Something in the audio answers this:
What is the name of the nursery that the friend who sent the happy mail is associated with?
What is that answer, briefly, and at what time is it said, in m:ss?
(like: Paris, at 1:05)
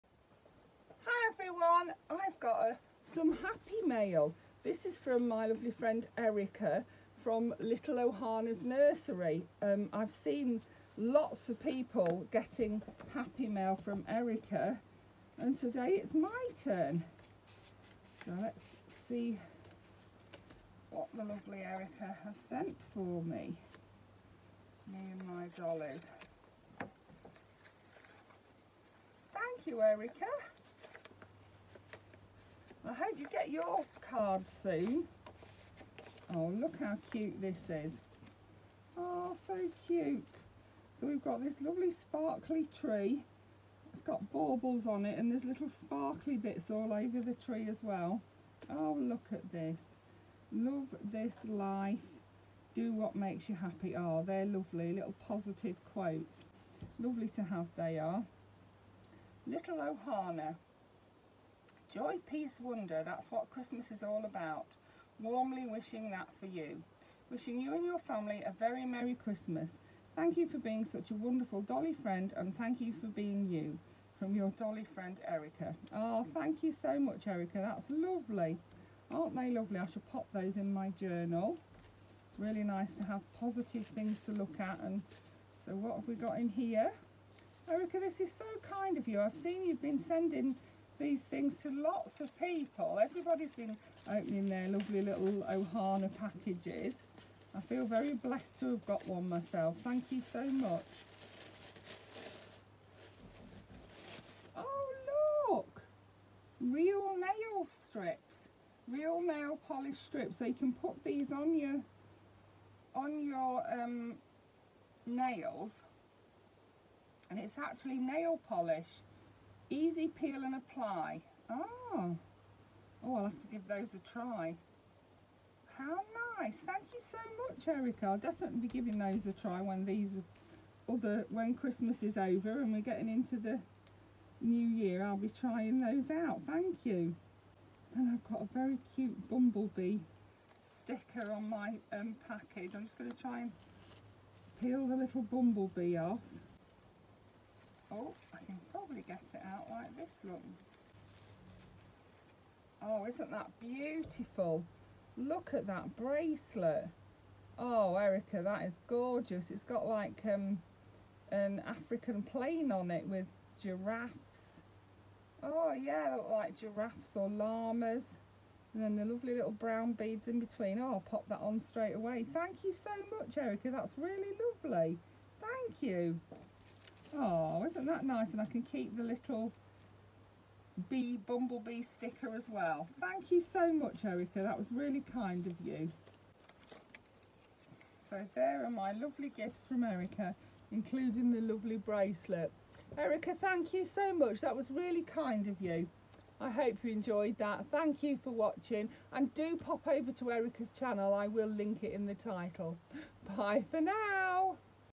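Little Ohana's Nursery, at 0:07.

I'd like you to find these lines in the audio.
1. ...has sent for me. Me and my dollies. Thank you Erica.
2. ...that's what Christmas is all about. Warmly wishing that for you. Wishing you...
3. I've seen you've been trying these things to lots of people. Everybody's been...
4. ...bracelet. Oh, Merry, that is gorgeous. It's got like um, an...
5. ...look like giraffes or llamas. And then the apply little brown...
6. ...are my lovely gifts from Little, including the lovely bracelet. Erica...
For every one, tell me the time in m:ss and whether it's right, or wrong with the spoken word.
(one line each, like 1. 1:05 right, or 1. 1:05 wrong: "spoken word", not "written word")
1. 0:22 right
2. 1:03 right
3. 1:29 wrong: "sending", not "trying"
4. 2:35 wrong: "Erica", not "Merry"
5. 2:46 wrong: "lovely", not "apply"
6. 3:08 wrong: "Erica", not "Little".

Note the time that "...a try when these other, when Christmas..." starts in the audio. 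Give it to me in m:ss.
2:09.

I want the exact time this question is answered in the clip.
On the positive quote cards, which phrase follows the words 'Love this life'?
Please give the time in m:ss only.
0:52.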